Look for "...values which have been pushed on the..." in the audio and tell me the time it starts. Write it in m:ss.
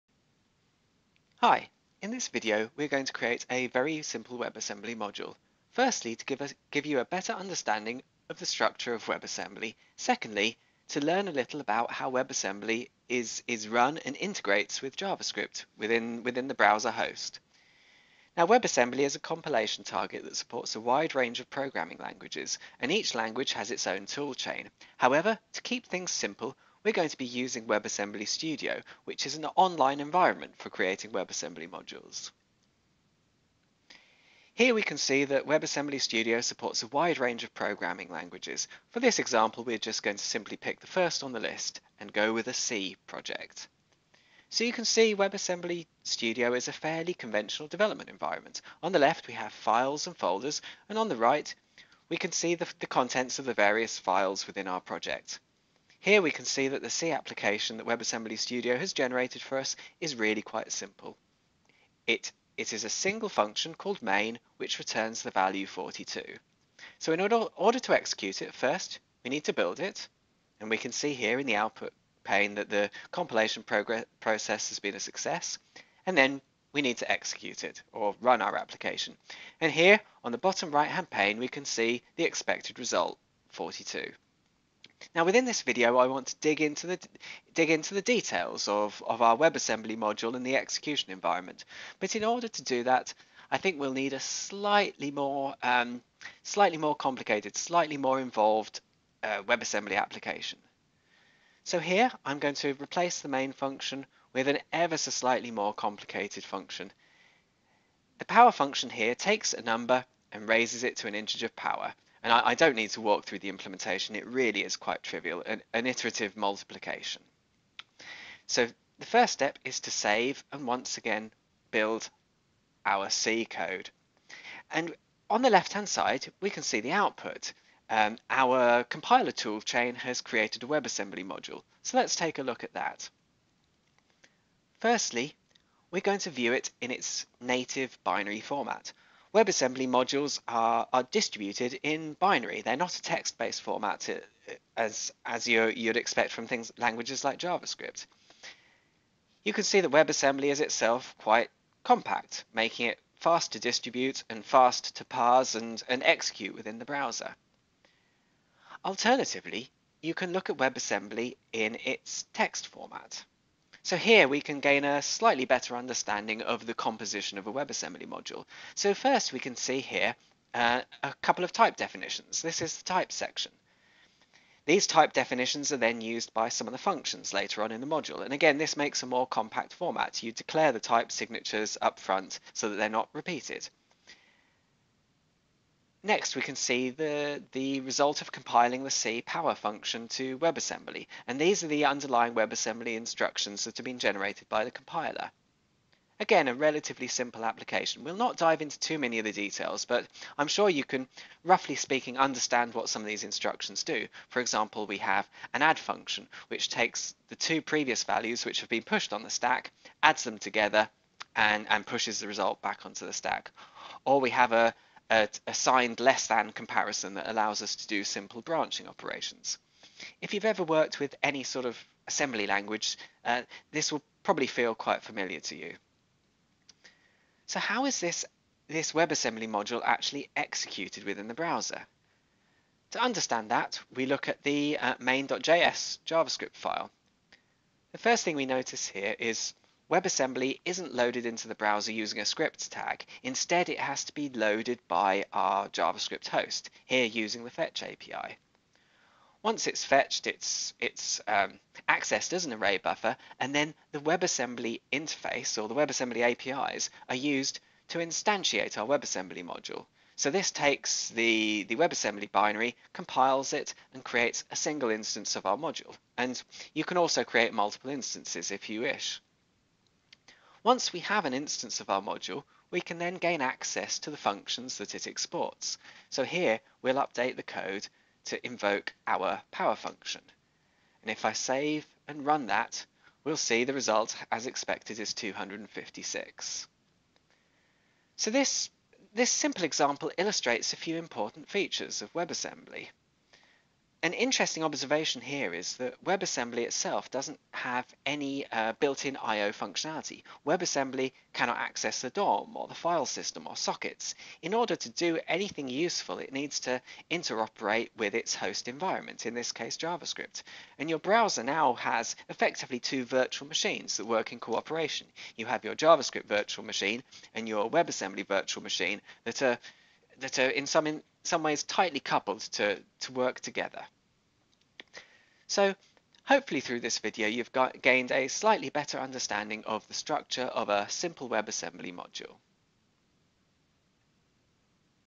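3:28.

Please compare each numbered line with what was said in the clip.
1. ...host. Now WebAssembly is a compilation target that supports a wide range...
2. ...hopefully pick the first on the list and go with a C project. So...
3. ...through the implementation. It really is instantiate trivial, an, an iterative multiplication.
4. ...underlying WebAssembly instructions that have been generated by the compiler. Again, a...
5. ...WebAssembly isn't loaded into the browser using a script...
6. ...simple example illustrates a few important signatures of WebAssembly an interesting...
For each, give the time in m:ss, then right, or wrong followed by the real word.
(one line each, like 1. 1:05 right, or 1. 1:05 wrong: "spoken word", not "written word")
1. 0:16 right
2. 0:40 wrong: "simply", not "hopefully"
3. 1:53 wrong: "quite", not "instantiate"
4. 3:11 right
5. 3:59 right
6. 4:49 wrong: "features", not "signatures".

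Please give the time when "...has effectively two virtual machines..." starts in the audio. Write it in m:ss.
5:11.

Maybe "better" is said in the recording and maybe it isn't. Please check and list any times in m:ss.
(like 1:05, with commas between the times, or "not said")
0:07, 2:45, 5:28.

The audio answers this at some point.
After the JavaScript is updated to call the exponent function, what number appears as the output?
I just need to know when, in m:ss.
4:45.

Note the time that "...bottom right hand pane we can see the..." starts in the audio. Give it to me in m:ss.
1:20.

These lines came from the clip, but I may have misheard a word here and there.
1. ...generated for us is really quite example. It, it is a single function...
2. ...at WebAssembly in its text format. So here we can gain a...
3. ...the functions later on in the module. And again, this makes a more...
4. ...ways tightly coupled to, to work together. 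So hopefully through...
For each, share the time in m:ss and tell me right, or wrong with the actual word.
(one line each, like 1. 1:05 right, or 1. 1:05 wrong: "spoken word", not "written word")
1. 0:58 wrong: "simple", not "example"
2. 2:40 right
3. 2:56 right
4. 5:21 right.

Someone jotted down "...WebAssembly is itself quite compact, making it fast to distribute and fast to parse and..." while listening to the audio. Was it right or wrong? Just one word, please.
right.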